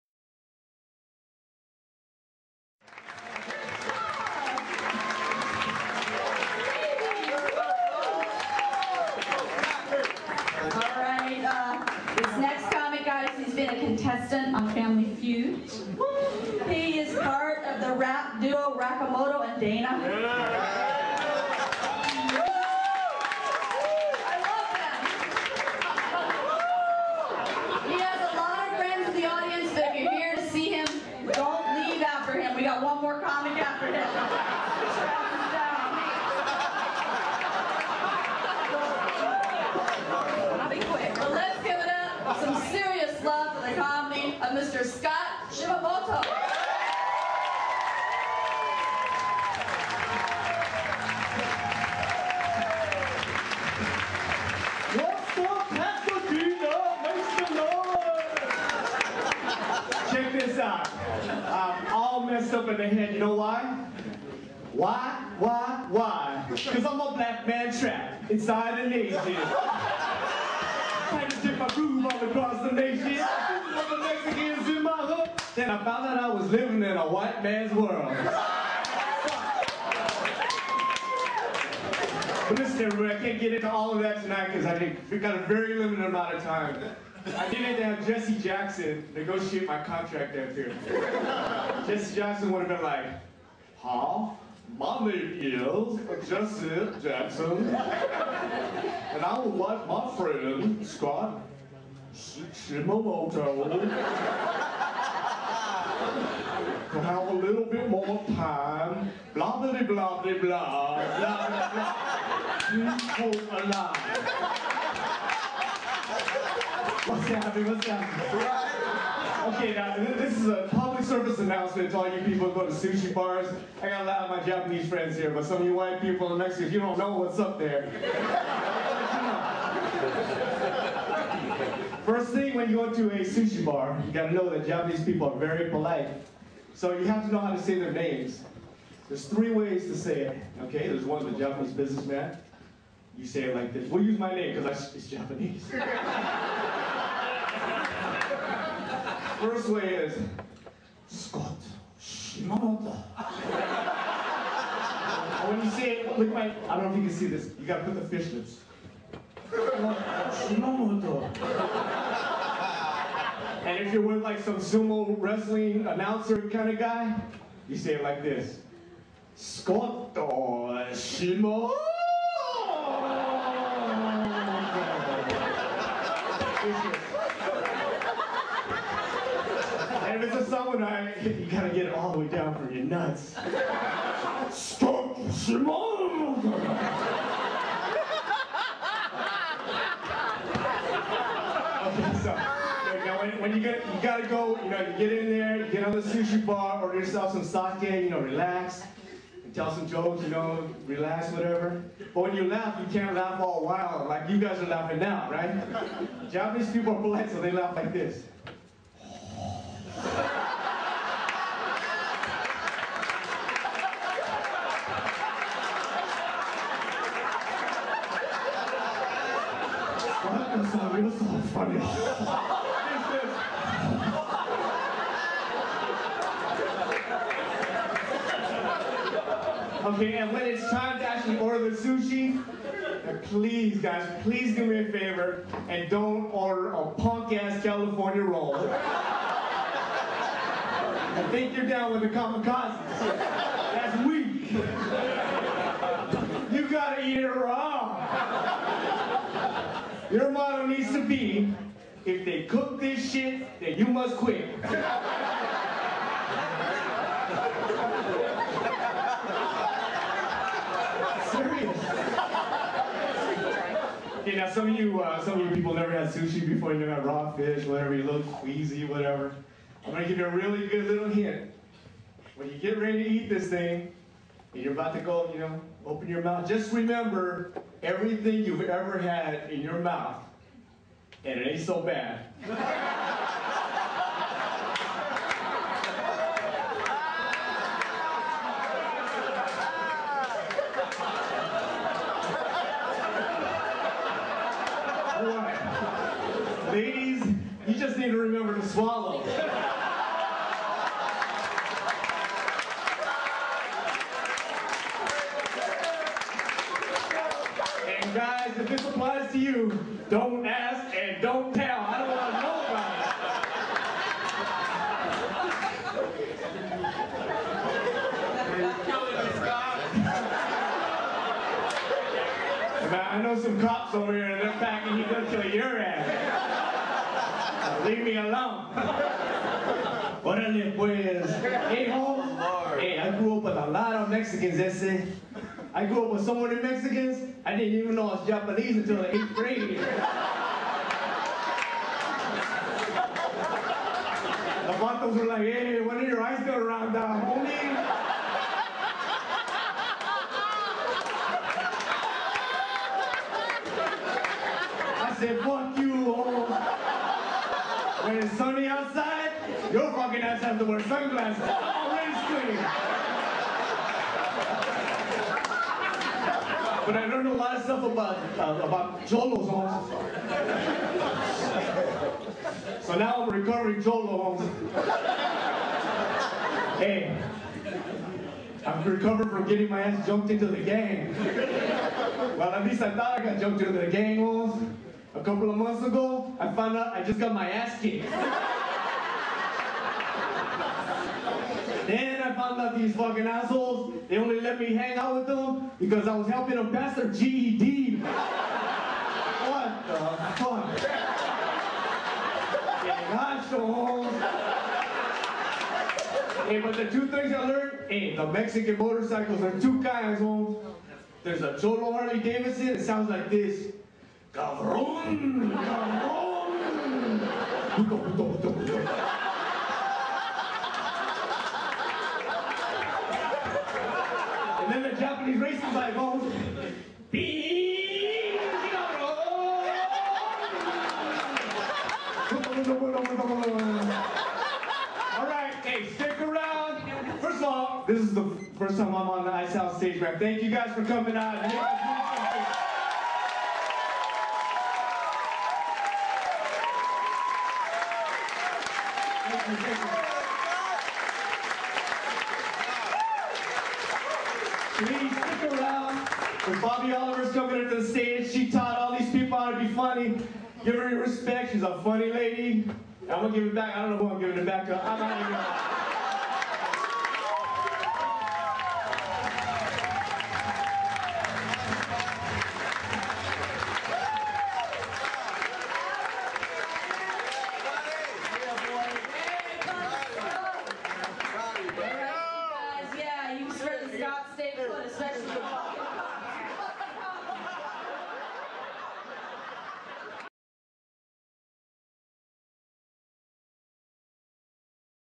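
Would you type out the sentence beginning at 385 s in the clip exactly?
A couple of months ago, I found out I just got my ass kicked.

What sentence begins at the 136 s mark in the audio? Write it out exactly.
So you have to know how to say their names.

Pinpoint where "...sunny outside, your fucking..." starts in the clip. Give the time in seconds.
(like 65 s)
358 s.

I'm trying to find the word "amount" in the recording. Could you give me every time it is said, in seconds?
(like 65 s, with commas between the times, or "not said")
86 s.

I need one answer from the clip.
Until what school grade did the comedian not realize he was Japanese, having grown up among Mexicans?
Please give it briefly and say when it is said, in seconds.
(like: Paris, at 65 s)
Eighth grade, at 339 s.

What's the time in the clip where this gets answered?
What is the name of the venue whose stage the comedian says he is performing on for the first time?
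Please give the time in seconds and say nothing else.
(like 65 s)
439 s.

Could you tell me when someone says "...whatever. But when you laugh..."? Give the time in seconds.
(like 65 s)
201 s.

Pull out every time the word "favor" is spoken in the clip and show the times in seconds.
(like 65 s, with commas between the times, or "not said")
234 s.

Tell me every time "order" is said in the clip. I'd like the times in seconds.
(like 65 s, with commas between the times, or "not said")
196 s, 231 s, 236 s.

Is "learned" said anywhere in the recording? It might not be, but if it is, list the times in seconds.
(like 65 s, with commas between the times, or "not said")
367 s, 407 s.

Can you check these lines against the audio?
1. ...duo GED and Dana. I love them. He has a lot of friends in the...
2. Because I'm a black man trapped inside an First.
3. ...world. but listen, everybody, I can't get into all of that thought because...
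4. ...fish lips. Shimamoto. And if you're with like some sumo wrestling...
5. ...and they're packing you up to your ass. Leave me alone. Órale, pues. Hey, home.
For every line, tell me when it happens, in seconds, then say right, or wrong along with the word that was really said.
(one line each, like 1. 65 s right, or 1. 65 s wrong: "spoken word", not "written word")
1. 18 s wrong: "Rakamoto", not "GED"
2. 66 s wrong: "Asian", not "First"
3. 77 s wrong: "tonight", not "thought"
4. 158 s right
5. 324 s right.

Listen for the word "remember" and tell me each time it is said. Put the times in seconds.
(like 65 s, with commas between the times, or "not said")
276 s, 298 s.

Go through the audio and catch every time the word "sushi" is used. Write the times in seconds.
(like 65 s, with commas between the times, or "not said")
122 s, 133 s, 196 s, 231 s, 266 s.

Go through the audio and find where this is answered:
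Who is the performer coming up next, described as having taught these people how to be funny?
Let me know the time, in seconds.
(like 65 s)
456 s.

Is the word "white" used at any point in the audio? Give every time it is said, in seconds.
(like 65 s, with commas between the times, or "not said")
77 s, 125 s.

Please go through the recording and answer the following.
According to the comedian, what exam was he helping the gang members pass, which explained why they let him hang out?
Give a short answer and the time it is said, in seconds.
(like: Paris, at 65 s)
GED, at 397 s.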